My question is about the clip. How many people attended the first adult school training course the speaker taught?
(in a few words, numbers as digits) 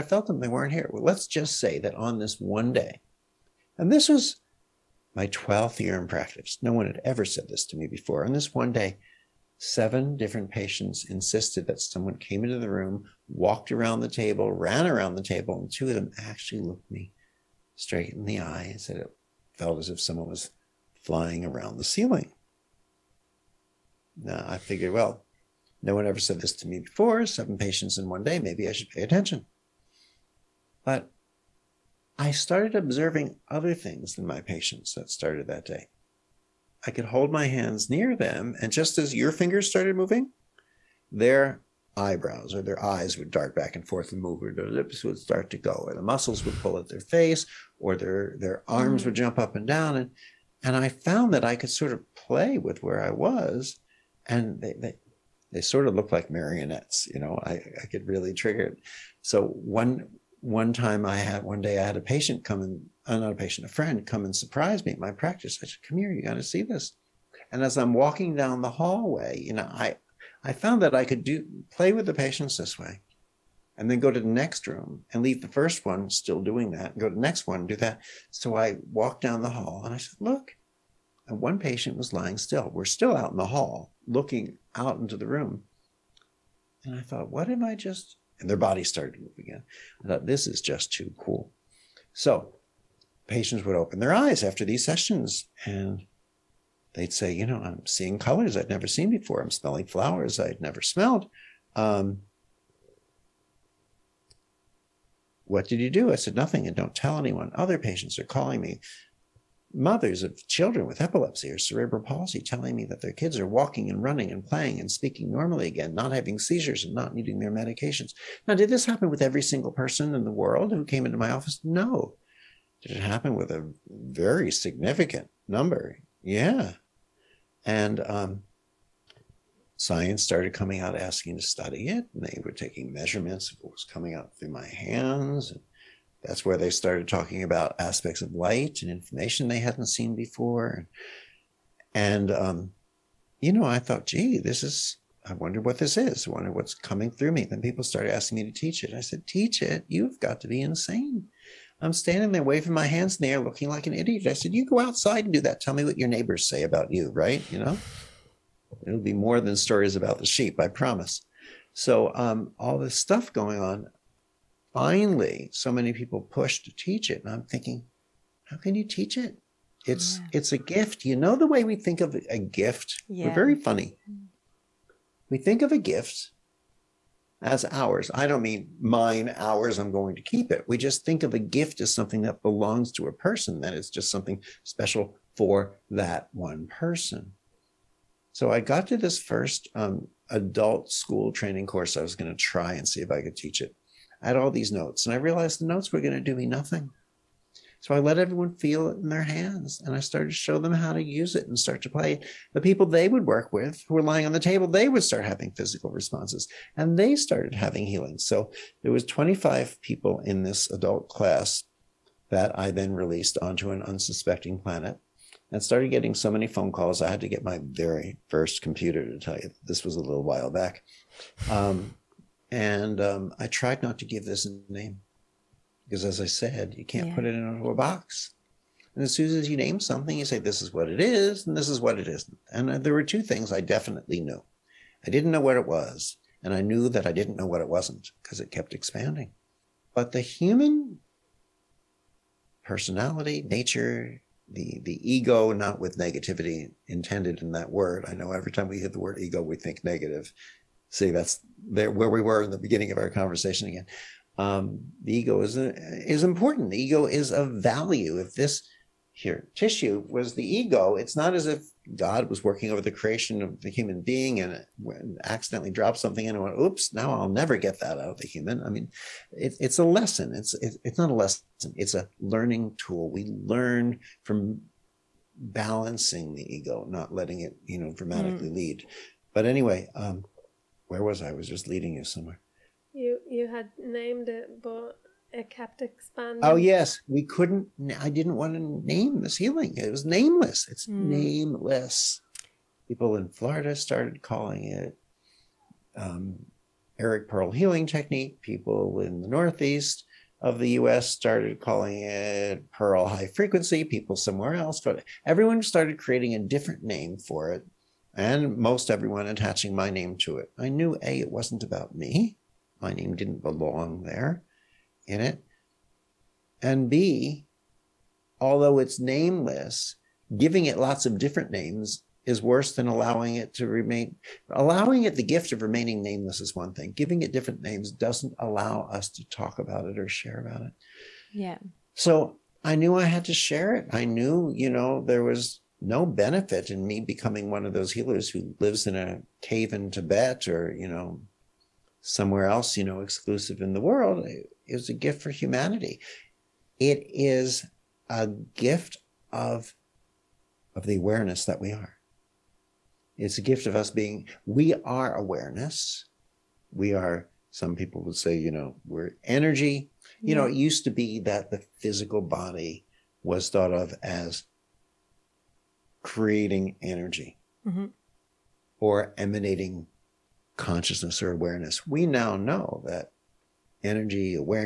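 25.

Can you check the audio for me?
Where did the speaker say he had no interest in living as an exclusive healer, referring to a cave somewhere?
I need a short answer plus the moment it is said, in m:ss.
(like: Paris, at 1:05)
Tibet, at 5:39.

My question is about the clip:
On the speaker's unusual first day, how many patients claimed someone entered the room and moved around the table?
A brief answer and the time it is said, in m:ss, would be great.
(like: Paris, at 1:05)
7, at 0:09.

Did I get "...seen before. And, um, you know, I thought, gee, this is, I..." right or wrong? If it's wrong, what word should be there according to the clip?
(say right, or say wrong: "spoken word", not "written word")
right.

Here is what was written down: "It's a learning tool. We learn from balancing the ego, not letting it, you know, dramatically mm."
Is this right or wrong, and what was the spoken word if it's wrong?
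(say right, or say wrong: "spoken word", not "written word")
right.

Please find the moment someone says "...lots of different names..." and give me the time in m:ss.
5:20.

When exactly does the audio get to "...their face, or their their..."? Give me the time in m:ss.
0:46.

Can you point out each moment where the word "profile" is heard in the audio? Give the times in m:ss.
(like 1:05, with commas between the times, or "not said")
not said.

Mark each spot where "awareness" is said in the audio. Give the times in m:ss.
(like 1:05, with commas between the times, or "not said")
5:50, 5:55, 6:11.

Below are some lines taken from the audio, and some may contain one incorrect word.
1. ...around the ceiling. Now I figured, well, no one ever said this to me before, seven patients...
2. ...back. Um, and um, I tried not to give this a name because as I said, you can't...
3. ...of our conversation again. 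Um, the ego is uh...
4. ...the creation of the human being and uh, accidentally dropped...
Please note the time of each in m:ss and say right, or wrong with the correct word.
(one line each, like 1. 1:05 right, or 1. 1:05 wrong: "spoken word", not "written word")
1. 0:21 right
2. 3:40 right
3. 4:12 right
4. 4:22 right.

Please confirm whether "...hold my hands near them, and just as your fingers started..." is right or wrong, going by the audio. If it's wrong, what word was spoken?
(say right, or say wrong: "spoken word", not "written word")
right.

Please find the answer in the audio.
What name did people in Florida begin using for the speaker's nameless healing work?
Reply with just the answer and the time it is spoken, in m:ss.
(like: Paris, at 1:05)
Eric Pearl healing technique, at 4:56.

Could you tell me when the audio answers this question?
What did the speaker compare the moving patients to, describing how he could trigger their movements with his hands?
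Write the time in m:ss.
0:56.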